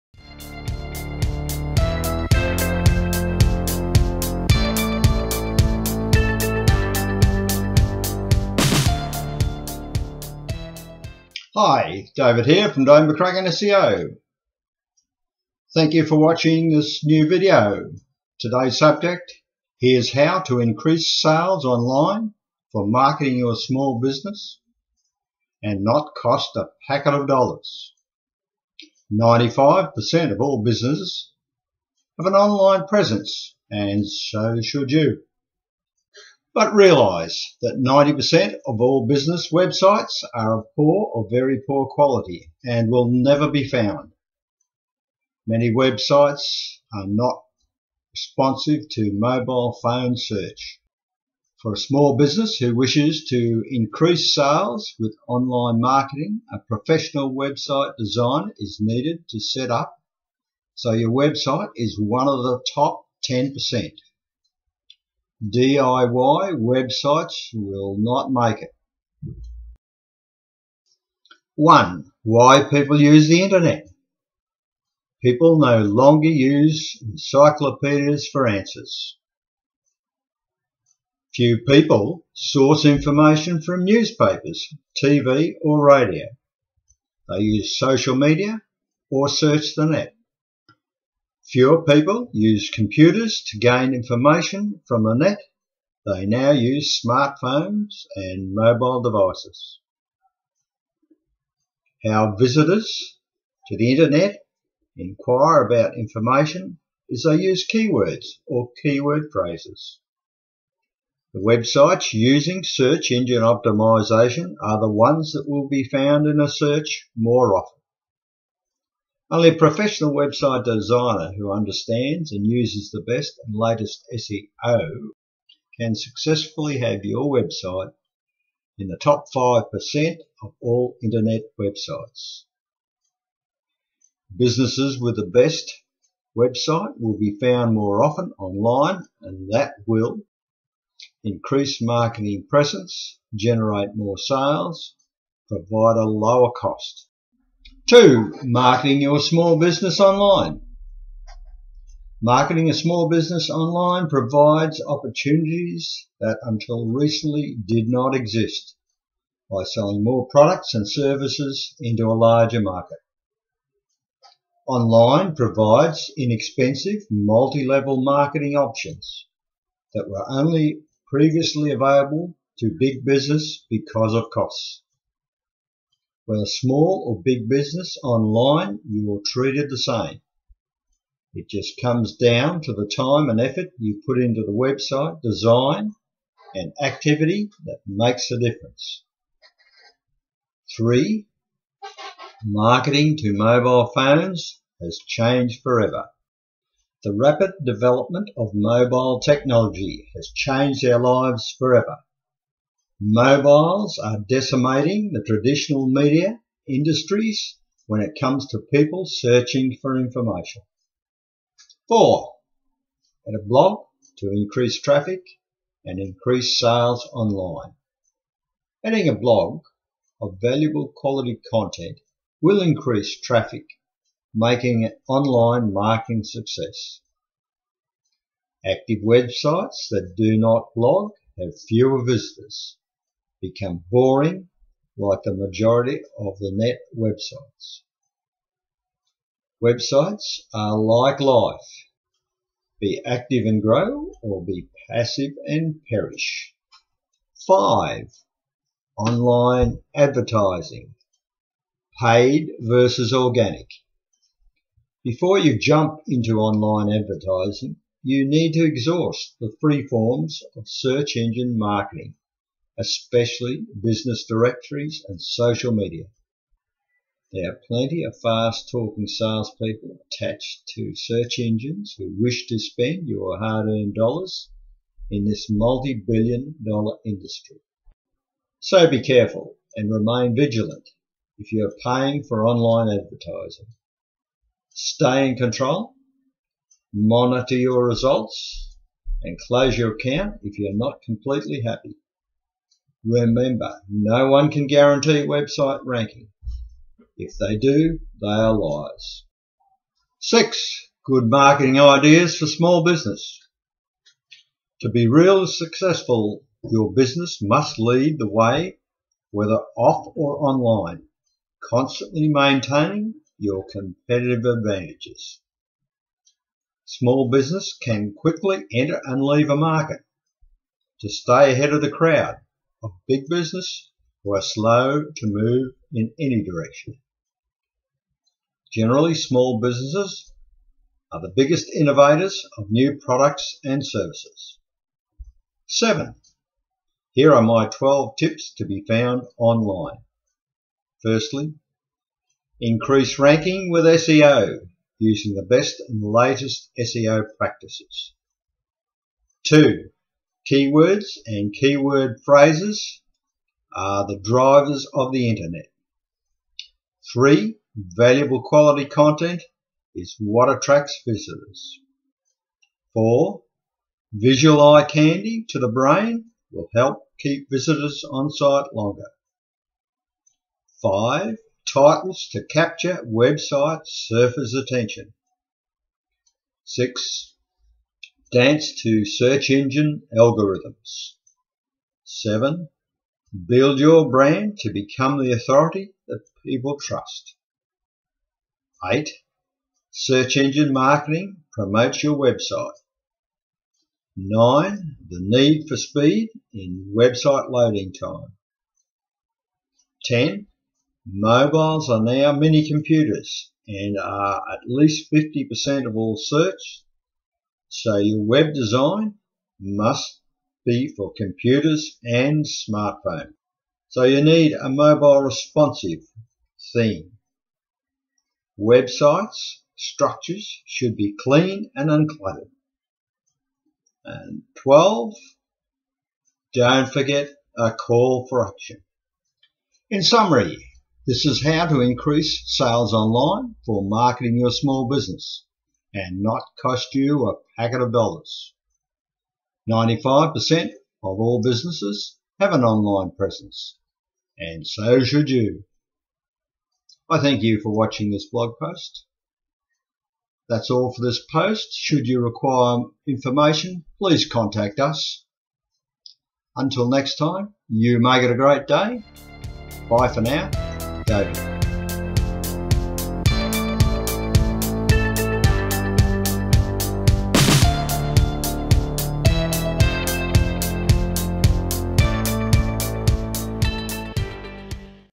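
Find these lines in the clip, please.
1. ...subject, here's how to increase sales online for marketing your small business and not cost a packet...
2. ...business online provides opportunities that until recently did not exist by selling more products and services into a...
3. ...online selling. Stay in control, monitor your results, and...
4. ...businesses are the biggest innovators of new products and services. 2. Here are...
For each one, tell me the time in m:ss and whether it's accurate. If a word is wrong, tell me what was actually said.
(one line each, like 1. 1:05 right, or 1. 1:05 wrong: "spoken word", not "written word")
1. 0:18 right
2. 2:33 right
3. 4:42 wrong: "advertising", not "selling"
4. 5:29 wrong: "7", not "2".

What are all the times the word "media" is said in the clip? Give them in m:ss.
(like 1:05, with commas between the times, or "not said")
1:28, 3:25, 4:25.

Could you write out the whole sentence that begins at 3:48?
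Active websites that do not blog have fewer visitors become boring like the majority of the net websites.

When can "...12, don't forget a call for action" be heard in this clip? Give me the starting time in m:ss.
7:04.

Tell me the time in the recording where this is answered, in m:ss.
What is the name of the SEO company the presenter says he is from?
0:12.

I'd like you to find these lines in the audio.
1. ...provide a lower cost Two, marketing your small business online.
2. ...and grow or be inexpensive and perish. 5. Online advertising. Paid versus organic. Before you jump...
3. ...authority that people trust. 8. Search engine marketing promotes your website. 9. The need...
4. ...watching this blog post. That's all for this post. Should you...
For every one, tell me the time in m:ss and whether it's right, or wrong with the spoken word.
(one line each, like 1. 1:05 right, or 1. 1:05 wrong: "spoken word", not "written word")
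1. 2:25 right
2. 4:03 wrong: "passive", not "inexpensive"
3. 6:25 right
4. 7:27 right.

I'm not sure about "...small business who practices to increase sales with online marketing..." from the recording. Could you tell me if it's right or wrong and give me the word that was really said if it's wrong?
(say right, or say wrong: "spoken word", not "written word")
wrong: "wishes", not "practices".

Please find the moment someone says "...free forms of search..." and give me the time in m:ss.
4:19.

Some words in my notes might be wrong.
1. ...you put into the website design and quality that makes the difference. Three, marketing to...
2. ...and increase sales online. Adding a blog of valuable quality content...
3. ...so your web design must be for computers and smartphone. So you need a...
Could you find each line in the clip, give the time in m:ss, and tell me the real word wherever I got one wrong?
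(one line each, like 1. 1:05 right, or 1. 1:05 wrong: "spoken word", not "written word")
1. 3:03 wrong: "activity", not "quality"
2. 3:35 right
3. 6:47 right.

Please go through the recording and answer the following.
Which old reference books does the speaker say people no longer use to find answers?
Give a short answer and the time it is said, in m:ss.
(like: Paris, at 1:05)
Encyclopedias, at 1:17.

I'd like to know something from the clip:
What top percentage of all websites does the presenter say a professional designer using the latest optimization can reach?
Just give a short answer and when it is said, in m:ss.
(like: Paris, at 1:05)
Top 5%, at 2:08.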